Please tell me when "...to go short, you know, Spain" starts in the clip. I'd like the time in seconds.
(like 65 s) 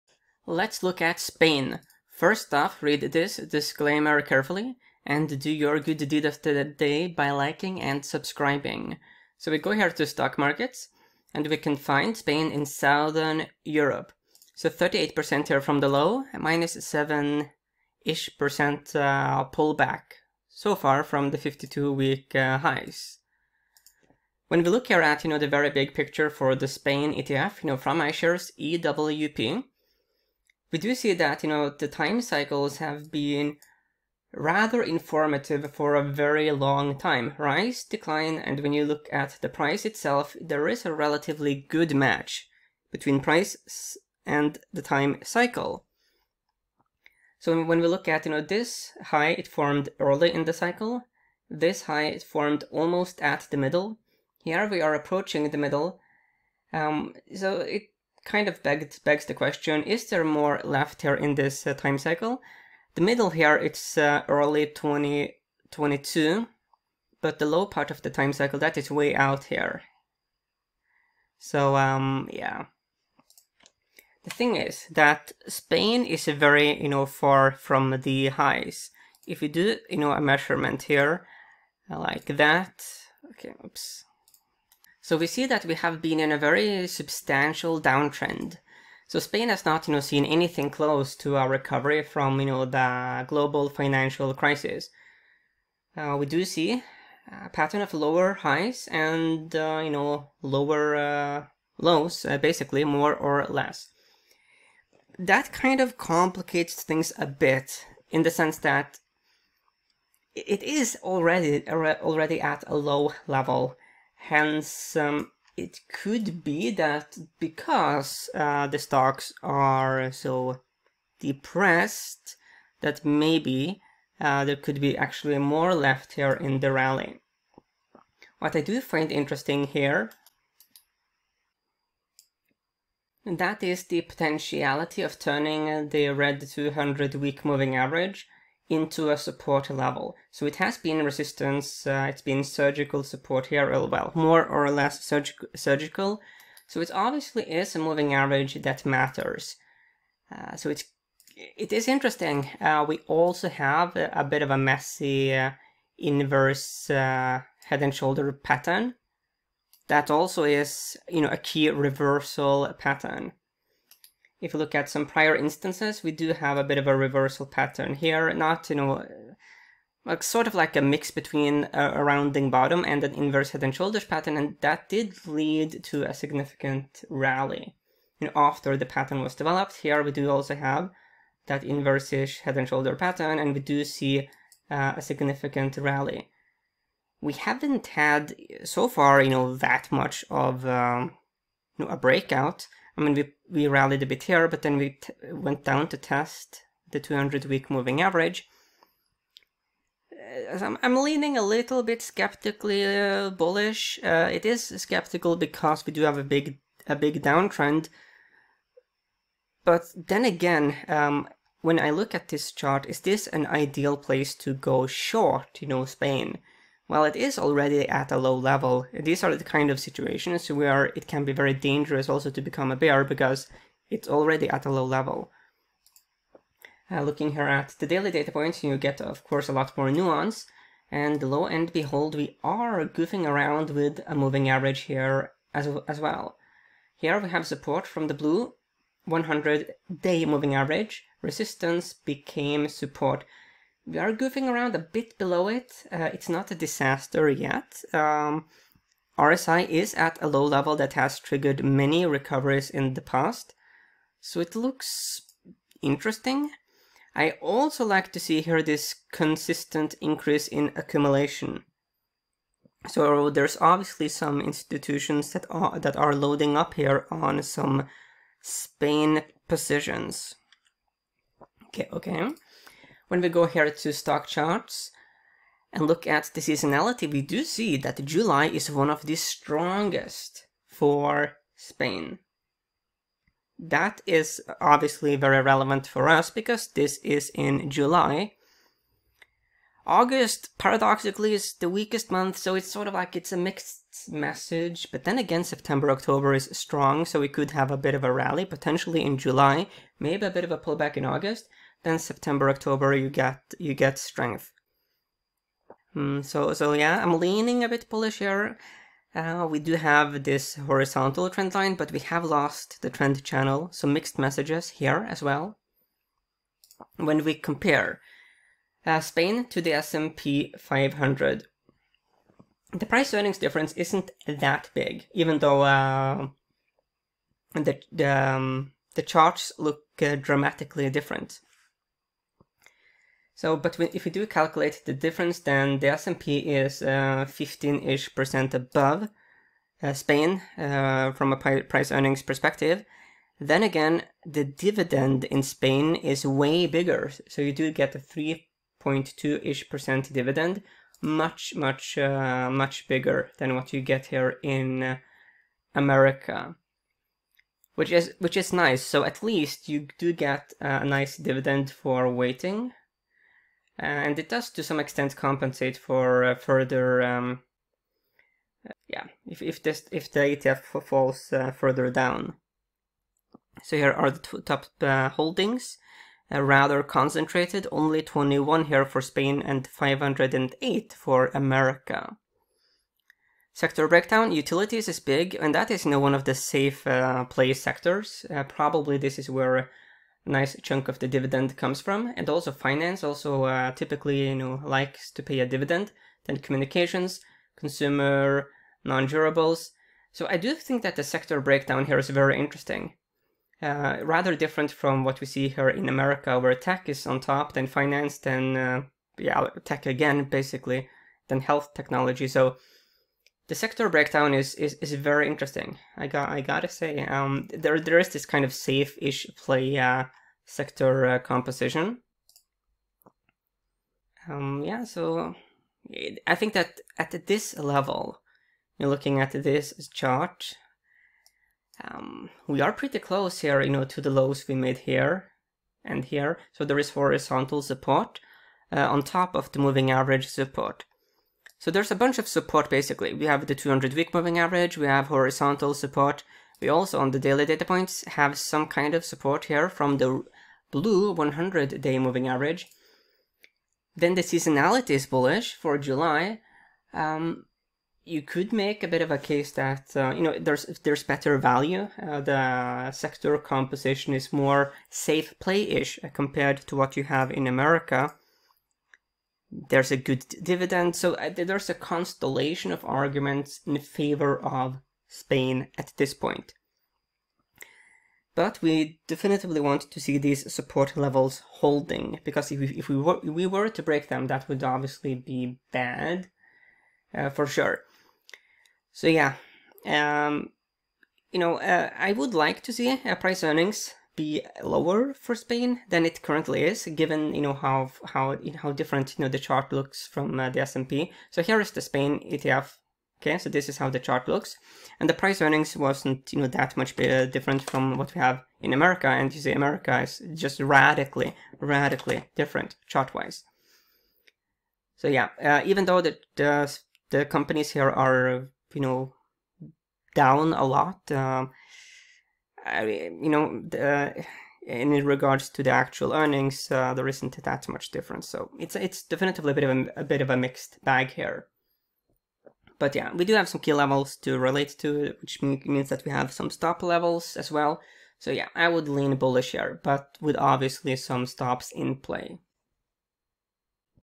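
214 s.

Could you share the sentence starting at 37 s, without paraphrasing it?
Rise, decline, and when you look at the price itself, there is a relatively good match between price and the time cycle.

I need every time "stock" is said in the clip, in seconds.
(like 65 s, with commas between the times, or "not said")
10 s, 118 s, 273 s.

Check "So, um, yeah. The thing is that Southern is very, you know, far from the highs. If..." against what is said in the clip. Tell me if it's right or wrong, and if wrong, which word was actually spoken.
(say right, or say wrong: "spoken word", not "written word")
wrong: "Spain", not "Southern".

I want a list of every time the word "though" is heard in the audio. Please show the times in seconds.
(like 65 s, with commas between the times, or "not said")
325 s, 515 s.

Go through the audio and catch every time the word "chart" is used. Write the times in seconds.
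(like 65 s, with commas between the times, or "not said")
212 s, 274 s, 329 s, 429 s, 499 s, 503 s, 512 s.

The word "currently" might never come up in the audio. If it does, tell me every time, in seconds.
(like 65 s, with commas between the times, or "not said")
496 s.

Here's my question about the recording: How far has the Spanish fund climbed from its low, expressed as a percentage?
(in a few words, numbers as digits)
38%.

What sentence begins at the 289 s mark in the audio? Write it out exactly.
August, paradoxically, is the weakest month, so it's sort of like it's a mixed message.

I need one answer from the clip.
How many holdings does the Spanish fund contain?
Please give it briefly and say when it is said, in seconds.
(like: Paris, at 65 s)
21, at 378 s.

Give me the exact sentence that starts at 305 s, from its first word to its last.
Mm, so so yeah, I'm leaning a bit bullish here.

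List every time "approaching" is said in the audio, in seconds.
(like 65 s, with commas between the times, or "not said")
54 s.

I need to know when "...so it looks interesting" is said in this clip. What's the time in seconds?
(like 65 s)
254 s.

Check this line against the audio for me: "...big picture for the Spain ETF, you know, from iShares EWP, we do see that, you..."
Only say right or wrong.
right.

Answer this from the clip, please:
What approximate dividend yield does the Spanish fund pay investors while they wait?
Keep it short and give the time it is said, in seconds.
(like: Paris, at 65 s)
3.2%, at 347 s.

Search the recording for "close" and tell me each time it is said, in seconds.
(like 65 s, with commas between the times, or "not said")
90 s, 432 s.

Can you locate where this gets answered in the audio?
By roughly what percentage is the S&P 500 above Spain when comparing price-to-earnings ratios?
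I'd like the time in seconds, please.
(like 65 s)
336 s.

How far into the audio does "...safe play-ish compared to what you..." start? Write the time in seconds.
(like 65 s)
464 s.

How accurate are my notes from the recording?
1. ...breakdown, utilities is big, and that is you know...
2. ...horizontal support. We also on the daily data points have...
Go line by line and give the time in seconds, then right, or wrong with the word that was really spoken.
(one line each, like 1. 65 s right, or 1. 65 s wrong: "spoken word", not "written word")
1. 383 s right
2. 445 s right.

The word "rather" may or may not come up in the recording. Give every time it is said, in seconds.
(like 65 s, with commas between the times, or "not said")
34 s, 376 s, 404 s.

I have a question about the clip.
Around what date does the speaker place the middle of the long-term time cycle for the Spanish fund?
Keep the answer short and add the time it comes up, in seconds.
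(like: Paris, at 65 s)
early 2022, at 64 s.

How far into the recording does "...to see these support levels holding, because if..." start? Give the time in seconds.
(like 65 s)
479 s.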